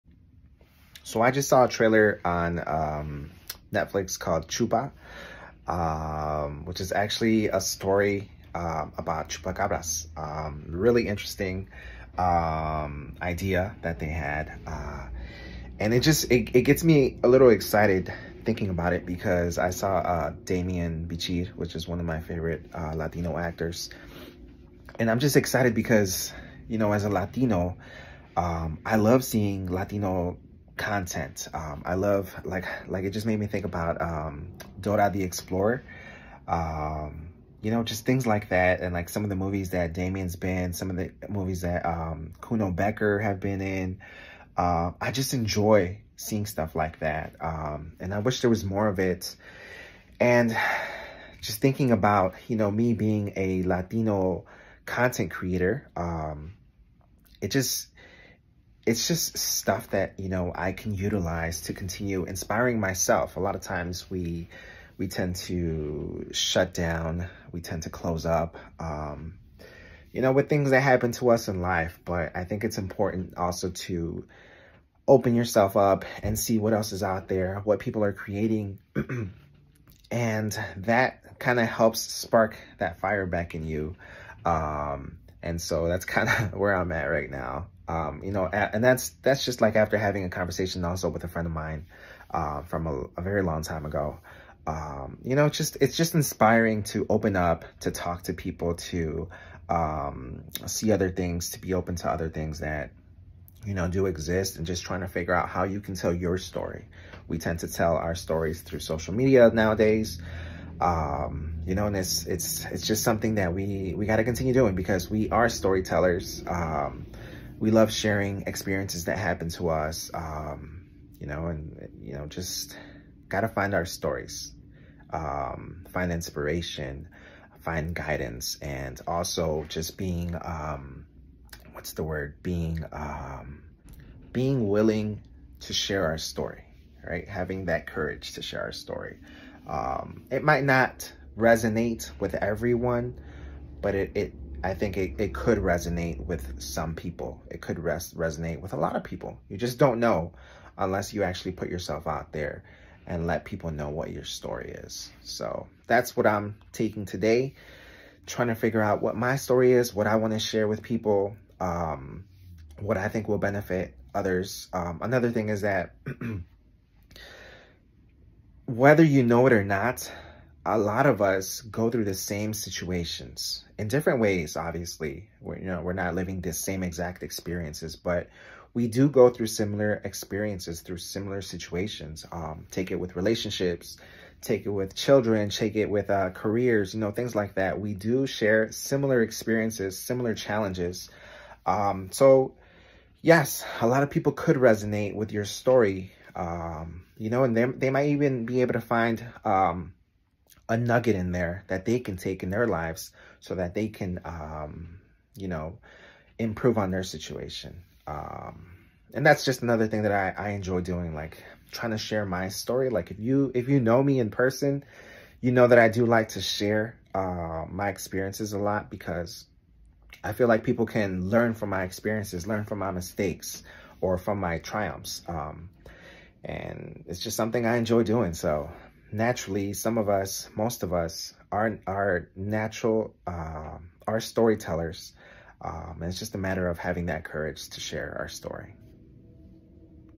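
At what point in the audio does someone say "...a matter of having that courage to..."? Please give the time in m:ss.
3:56.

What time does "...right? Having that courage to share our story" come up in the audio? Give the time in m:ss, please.
2:17.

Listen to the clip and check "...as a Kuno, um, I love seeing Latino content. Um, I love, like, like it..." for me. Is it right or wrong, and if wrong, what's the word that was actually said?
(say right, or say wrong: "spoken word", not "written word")
wrong: "Latino", not "Kuno".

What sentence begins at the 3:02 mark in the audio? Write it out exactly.
Um, take it with relationships, take it with children, take it with uh, careers, you know, things like that.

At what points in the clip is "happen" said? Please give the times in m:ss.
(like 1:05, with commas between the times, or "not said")
1:10, 1:59.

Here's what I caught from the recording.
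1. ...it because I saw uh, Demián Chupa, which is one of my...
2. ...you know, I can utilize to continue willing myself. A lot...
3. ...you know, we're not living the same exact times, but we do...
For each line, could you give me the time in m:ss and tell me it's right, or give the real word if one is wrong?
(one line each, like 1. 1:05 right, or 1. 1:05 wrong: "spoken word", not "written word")
1. 0:18 wrong: "Bichir", not "Chupa"
2. 1:00 wrong: "inspiring", not "willing"
3. 2:55 wrong: "experiences", not "times".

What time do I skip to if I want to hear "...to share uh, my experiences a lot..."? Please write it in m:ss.
3:36.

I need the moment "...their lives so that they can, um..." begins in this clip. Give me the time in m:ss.
3:22.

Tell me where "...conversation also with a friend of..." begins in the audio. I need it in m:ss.
1:30.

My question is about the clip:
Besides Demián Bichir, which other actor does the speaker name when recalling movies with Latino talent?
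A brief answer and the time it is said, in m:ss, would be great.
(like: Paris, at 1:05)
Kuno Becker, at 0:42.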